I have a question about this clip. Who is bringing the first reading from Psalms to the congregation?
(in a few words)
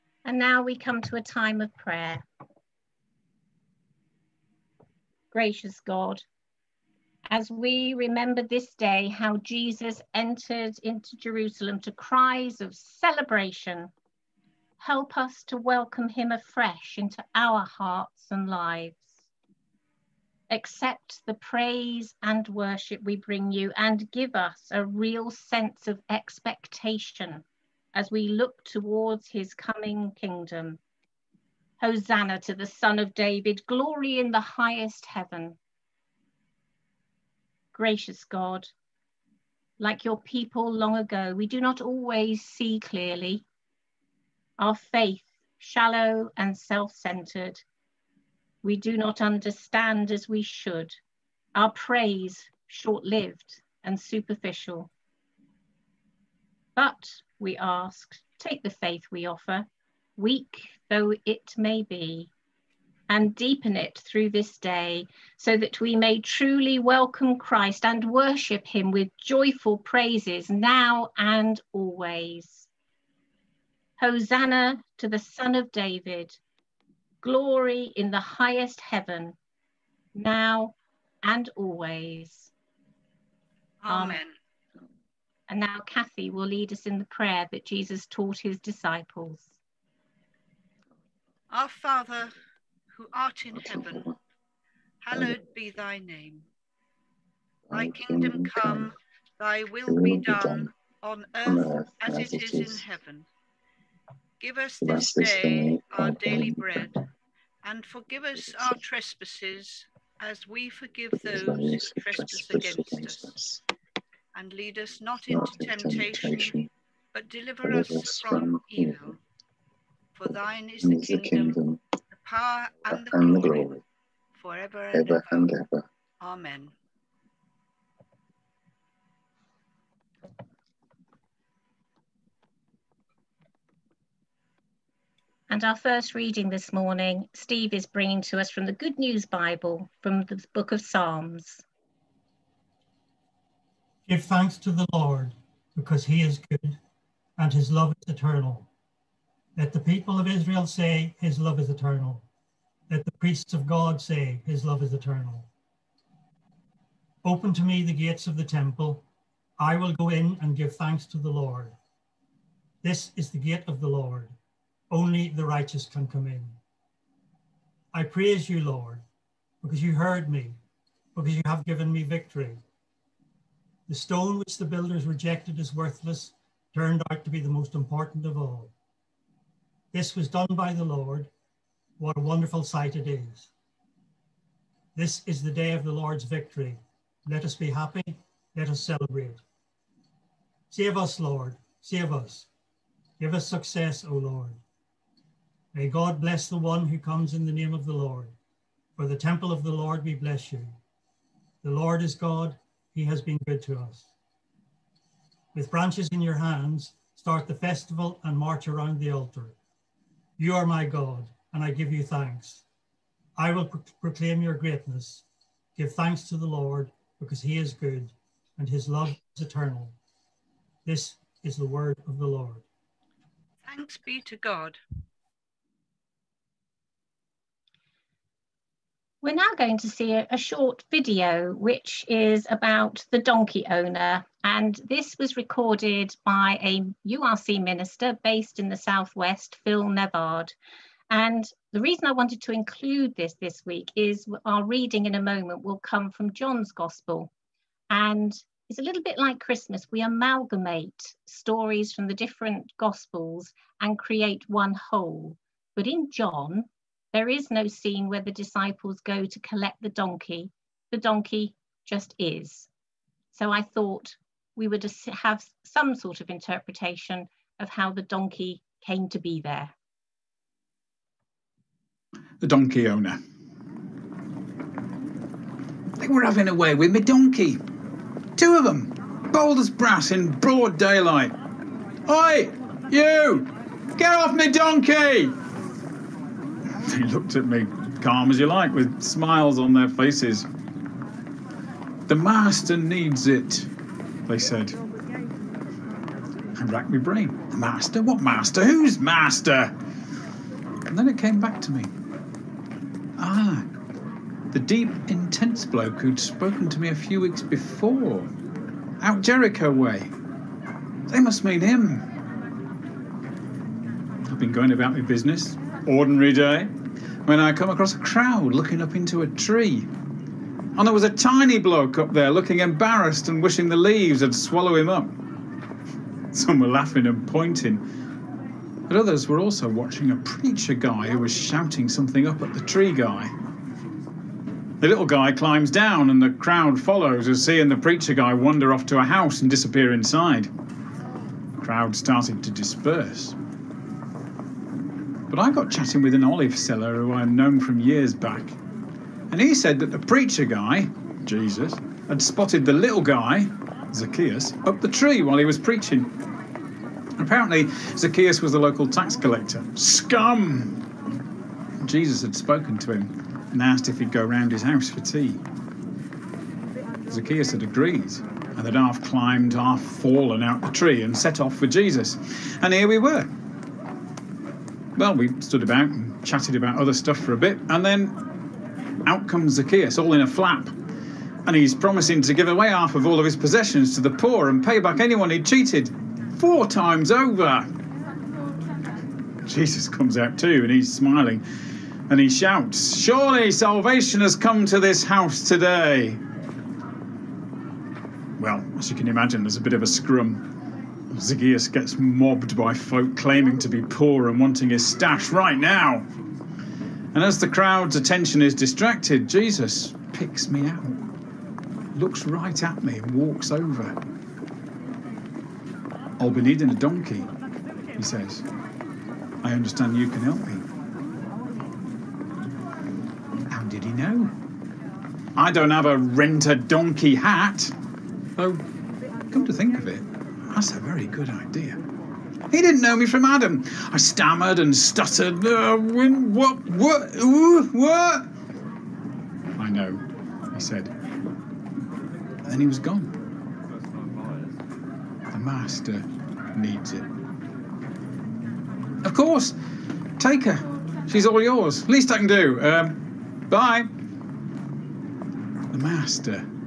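Steve.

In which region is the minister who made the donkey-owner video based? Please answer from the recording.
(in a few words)
the Southwest.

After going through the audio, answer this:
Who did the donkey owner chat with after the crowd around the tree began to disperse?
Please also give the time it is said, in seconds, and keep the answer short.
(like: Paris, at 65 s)
an olive seller, at 346 s.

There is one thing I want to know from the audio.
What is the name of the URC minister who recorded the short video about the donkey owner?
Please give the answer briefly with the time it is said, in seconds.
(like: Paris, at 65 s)
Phil Nevard, at 239 s.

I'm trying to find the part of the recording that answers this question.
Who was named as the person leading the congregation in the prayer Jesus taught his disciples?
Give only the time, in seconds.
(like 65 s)
85 s.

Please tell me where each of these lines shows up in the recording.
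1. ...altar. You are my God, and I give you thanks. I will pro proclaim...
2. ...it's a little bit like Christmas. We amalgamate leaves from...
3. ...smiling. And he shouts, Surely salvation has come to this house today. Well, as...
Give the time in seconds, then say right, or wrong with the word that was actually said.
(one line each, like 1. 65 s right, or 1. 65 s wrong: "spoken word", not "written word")
1. 209 s right
2. 248 s wrong: "stories", not "leaves"
3. 390 s right.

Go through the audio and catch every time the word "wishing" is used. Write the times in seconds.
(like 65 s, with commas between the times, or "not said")
323 s.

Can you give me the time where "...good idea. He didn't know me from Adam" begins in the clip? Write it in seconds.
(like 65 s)
431 s.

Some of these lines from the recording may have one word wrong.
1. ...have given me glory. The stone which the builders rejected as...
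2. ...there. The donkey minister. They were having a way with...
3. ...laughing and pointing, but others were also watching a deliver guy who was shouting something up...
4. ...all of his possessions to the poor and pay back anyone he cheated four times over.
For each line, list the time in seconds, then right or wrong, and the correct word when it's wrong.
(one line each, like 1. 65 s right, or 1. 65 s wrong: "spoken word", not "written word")
1. 171 s wrong: "victory", not "glory"
2. 269 s wrong: "owner", not "minister"
3. 326 s wrong: "preacher", not "deliver"
4. 383 s right.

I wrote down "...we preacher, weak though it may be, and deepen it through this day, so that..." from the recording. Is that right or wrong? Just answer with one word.
wrong.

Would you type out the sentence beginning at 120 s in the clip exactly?
For thine is the kingdom, the power, and the glory, forever and ever.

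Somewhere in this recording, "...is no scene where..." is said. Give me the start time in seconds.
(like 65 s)
257 s.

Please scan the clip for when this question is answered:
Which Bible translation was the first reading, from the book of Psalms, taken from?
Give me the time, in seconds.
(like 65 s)
138 s.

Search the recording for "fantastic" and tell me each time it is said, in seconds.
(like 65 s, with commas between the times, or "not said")
not said.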